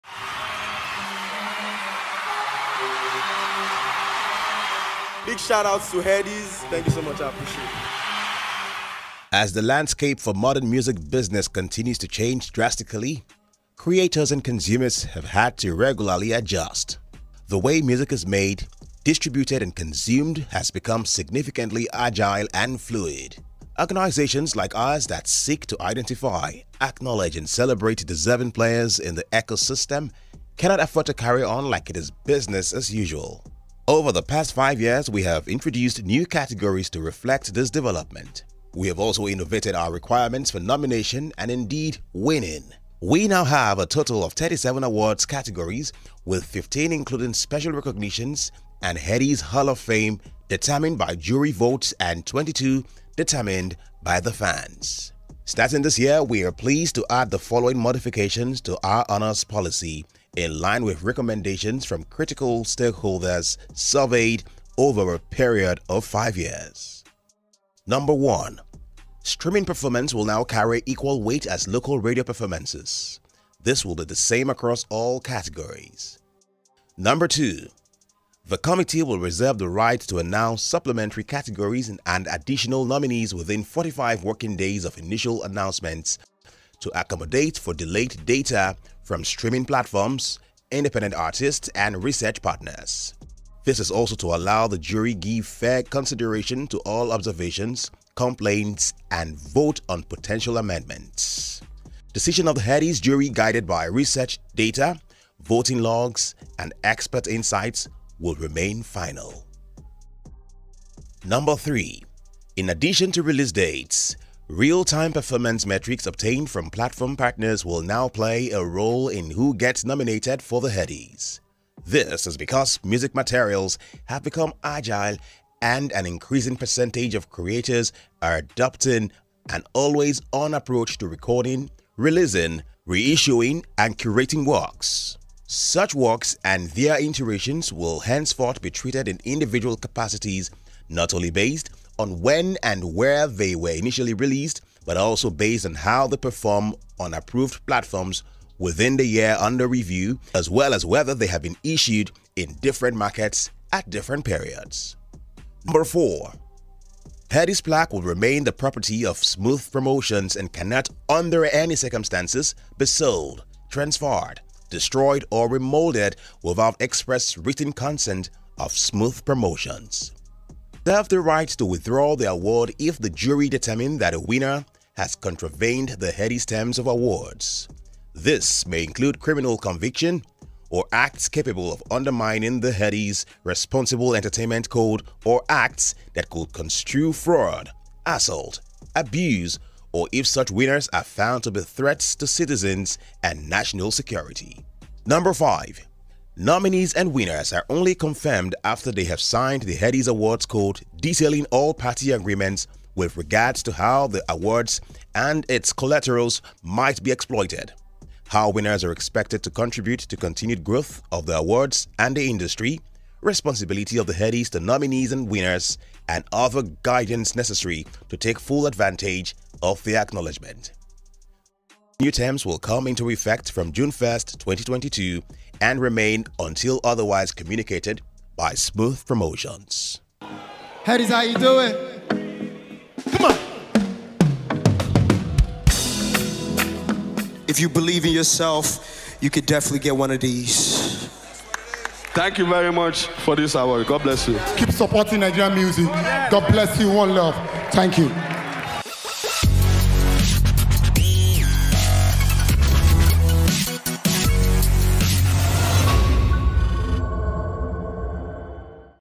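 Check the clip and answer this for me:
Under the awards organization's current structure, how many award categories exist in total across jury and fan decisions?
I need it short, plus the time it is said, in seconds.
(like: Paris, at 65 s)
37, at 44 s.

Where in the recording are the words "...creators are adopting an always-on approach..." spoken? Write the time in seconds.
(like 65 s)
127 s.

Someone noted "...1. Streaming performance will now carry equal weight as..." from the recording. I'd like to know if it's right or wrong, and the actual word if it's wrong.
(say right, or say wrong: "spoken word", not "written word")
right.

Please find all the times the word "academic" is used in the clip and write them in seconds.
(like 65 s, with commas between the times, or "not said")
not said.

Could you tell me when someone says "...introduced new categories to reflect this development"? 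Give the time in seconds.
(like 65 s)
35 s.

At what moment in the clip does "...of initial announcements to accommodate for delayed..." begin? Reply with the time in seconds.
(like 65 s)
84 s.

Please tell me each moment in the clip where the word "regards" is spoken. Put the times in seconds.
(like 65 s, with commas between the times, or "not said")
203 s.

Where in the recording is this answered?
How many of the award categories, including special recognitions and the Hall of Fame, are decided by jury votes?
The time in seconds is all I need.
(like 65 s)
46 s.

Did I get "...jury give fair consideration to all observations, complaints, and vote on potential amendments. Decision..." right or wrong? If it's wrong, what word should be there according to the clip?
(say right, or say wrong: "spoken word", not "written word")
right.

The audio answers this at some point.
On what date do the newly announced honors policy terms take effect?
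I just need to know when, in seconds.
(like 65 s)
223 s.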